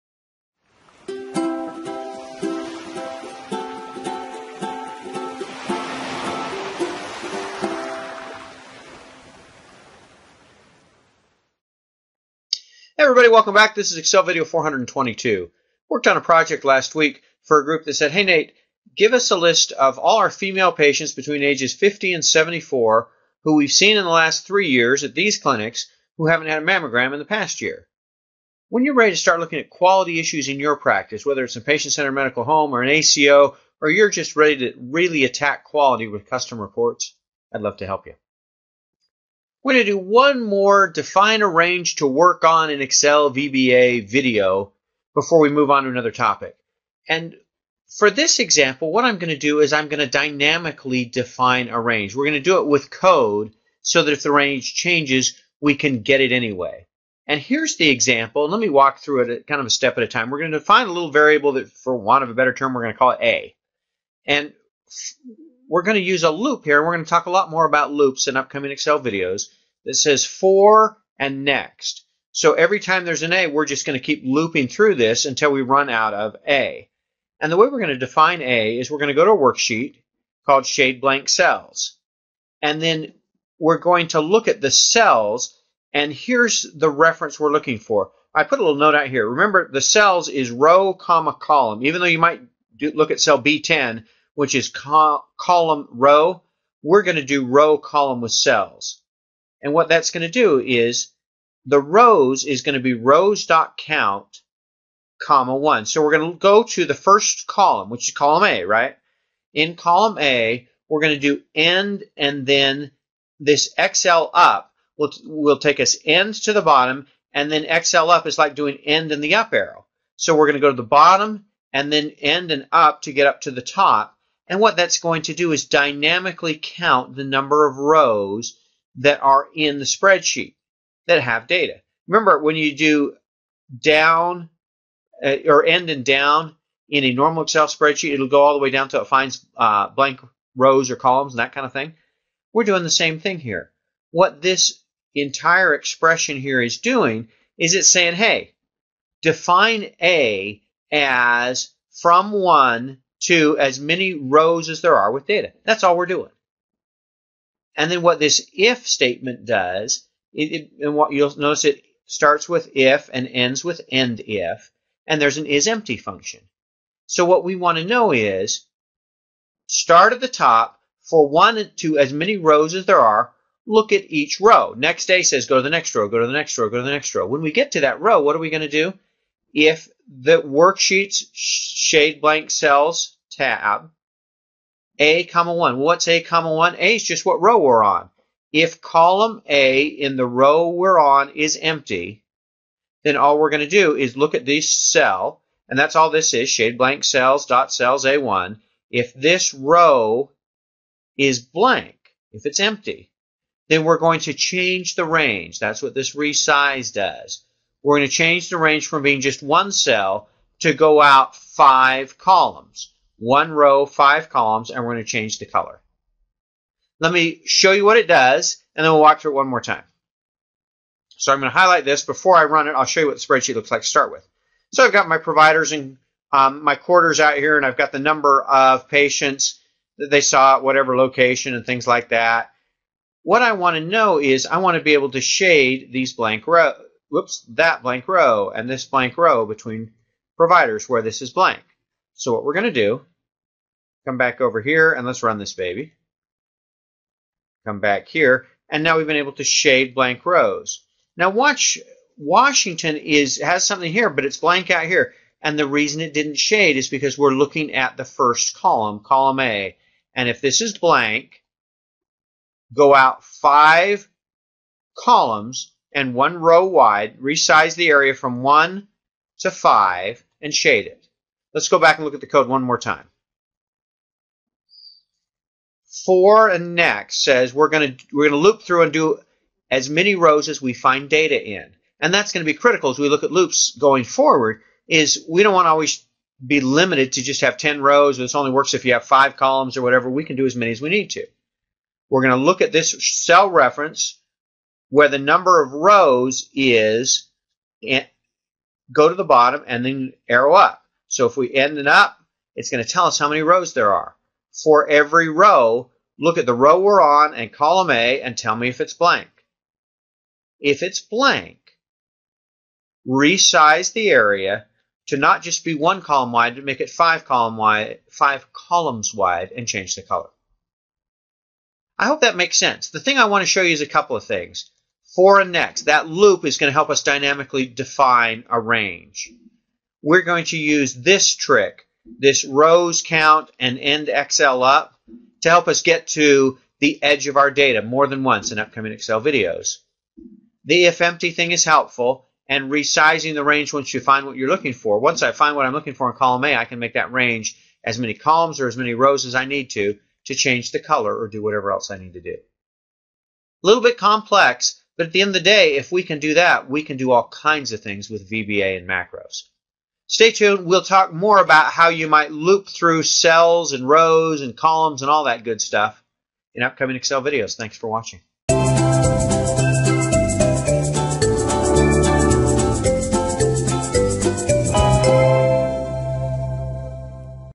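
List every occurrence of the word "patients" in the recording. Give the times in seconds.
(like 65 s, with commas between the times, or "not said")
20 s, 31 s, 228 s.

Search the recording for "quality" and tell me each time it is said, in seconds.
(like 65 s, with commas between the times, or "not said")
29 s, 35 s.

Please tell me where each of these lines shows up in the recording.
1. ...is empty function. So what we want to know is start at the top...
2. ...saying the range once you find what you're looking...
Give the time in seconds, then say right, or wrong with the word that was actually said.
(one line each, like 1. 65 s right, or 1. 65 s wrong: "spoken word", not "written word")
1. 165 s right
2. 342 s wrong: "resizing", not "saying".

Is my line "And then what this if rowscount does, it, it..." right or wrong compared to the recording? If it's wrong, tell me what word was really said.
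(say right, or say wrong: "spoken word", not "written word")
wrong: "statement", not "rowscount".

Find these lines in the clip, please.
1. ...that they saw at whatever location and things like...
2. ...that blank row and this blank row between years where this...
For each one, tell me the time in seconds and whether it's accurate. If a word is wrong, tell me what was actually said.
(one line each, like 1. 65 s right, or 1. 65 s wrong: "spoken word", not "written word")
1. 229 s right
2. 237 s wrong: "providers", not "years".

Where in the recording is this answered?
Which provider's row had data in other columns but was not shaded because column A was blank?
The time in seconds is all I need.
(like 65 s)
252 s.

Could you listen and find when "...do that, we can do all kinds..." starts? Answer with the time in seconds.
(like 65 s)
356 s.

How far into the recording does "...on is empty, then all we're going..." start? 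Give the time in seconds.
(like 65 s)
190 s.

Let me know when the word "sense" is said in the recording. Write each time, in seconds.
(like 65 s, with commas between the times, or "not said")
322 s.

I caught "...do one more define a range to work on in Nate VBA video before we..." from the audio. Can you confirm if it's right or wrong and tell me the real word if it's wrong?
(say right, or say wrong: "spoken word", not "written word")
wrong: "Excel", not "Nate".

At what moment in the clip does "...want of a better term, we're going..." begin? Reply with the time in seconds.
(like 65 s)
61 s.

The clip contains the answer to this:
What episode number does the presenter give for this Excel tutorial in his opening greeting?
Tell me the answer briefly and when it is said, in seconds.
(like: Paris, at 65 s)
422, at 14 s.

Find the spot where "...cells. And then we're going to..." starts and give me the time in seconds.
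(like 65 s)
81 s.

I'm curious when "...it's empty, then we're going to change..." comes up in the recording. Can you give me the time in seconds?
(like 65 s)
202 s.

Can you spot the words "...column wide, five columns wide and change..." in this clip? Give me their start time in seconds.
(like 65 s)
317 s.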